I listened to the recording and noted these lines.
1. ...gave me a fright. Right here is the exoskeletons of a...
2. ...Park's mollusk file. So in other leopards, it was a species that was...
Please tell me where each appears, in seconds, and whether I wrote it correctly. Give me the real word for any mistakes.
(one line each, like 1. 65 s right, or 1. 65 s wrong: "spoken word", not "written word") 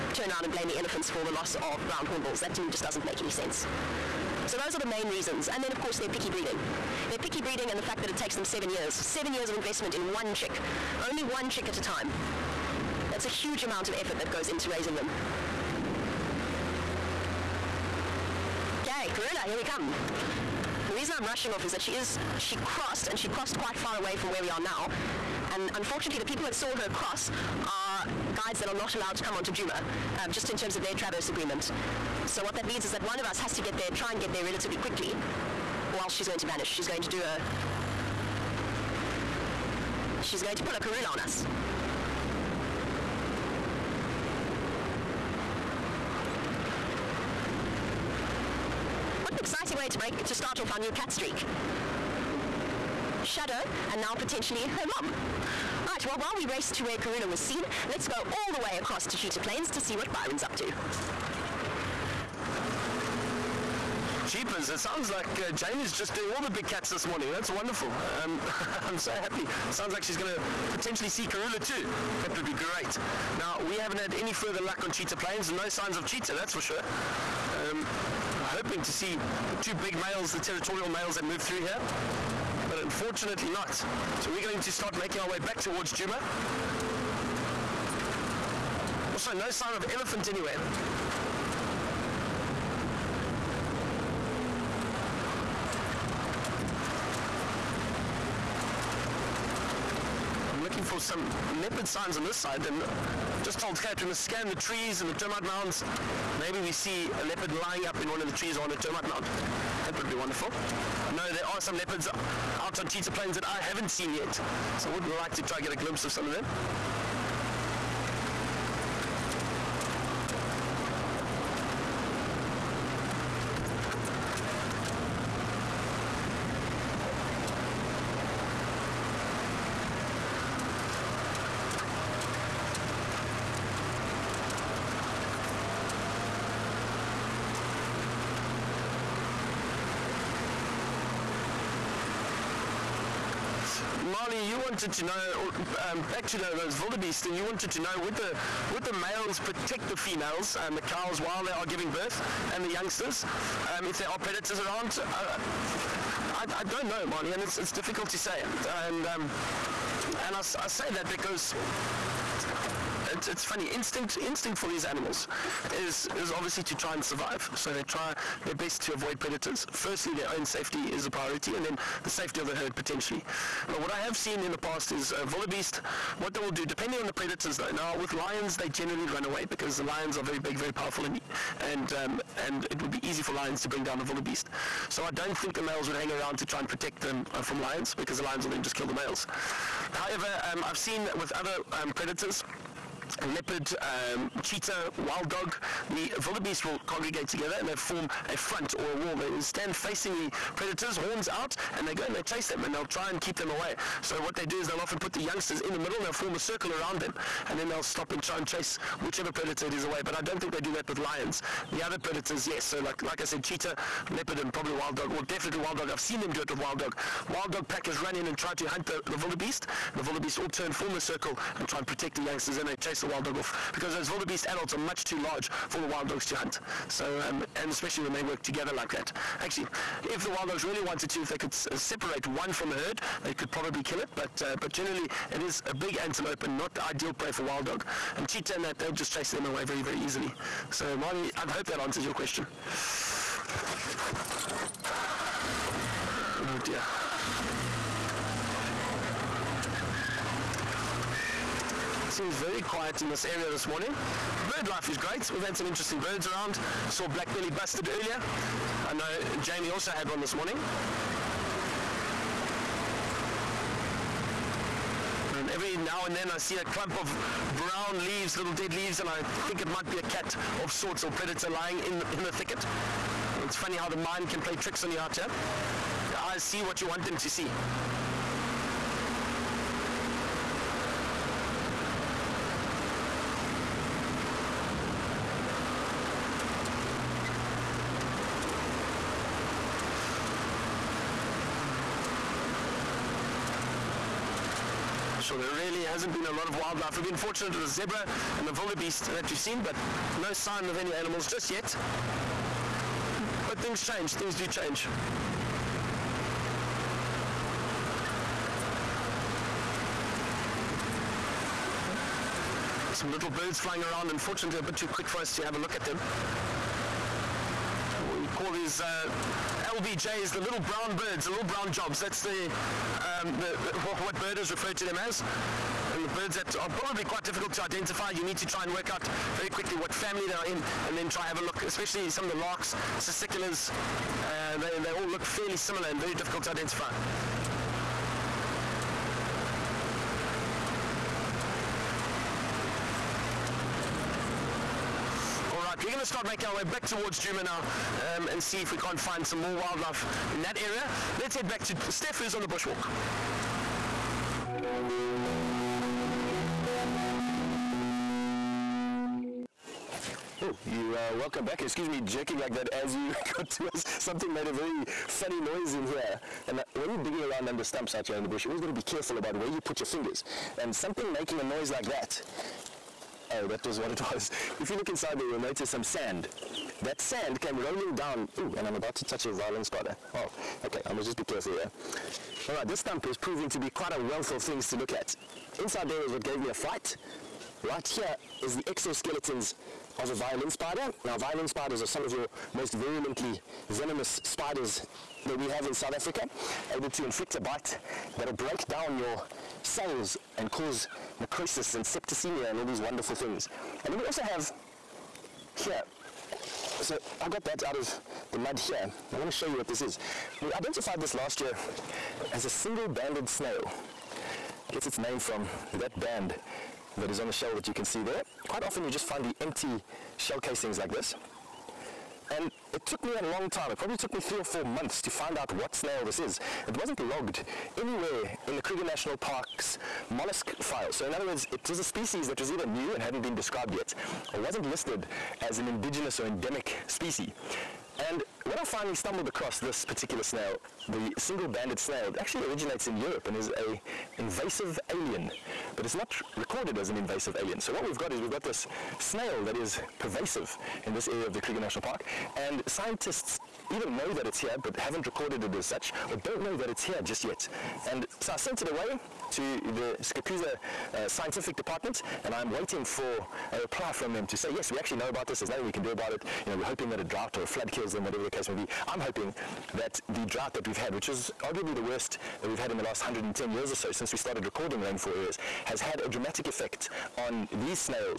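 1. 386 s right
2. 429 s wrong: "words", not "leopards".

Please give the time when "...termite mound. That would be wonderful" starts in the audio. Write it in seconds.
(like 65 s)
108 s.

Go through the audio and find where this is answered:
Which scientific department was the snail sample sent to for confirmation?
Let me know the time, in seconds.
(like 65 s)
460 s.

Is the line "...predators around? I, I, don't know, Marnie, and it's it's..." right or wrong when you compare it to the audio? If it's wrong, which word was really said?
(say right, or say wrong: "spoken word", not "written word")
right.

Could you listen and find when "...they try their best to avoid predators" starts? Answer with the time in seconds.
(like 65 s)
167 s.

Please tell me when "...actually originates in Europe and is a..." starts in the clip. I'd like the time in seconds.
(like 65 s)
442 s.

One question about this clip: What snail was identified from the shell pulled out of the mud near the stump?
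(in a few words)
Single banded snail.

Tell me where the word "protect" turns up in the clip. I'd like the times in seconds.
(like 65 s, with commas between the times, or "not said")
149 s, 186 s, 221 s.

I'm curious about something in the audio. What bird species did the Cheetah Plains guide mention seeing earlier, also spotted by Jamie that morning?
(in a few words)
Black-bellied bustard.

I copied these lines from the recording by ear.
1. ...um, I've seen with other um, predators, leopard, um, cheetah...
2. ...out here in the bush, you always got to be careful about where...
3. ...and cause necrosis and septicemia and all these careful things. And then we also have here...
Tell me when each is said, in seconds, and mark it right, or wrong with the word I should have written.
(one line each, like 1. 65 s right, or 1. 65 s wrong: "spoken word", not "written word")
1. 190 s right
2. 367 s right
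3. 400 s wrong: "wonderful", not "careful".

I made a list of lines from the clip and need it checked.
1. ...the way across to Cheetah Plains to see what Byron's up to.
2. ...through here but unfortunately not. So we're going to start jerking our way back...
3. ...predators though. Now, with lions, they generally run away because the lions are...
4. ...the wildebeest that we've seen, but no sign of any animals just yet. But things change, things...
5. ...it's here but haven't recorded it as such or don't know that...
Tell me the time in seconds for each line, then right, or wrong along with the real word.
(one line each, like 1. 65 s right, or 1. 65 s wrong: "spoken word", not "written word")
1. 58 s right
2. 81 s wrong: "making", not "jerking"
3. 177 s right
4. 298 s right
5. 454 s right.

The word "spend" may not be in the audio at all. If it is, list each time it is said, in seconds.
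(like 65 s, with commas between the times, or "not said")
not said.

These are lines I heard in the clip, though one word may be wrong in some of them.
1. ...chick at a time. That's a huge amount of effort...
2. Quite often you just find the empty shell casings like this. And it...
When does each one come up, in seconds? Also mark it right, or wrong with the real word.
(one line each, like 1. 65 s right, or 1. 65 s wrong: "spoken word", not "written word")
1. 11 s right
2. 418 s right.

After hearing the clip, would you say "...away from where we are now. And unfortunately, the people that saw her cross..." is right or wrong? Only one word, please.
right.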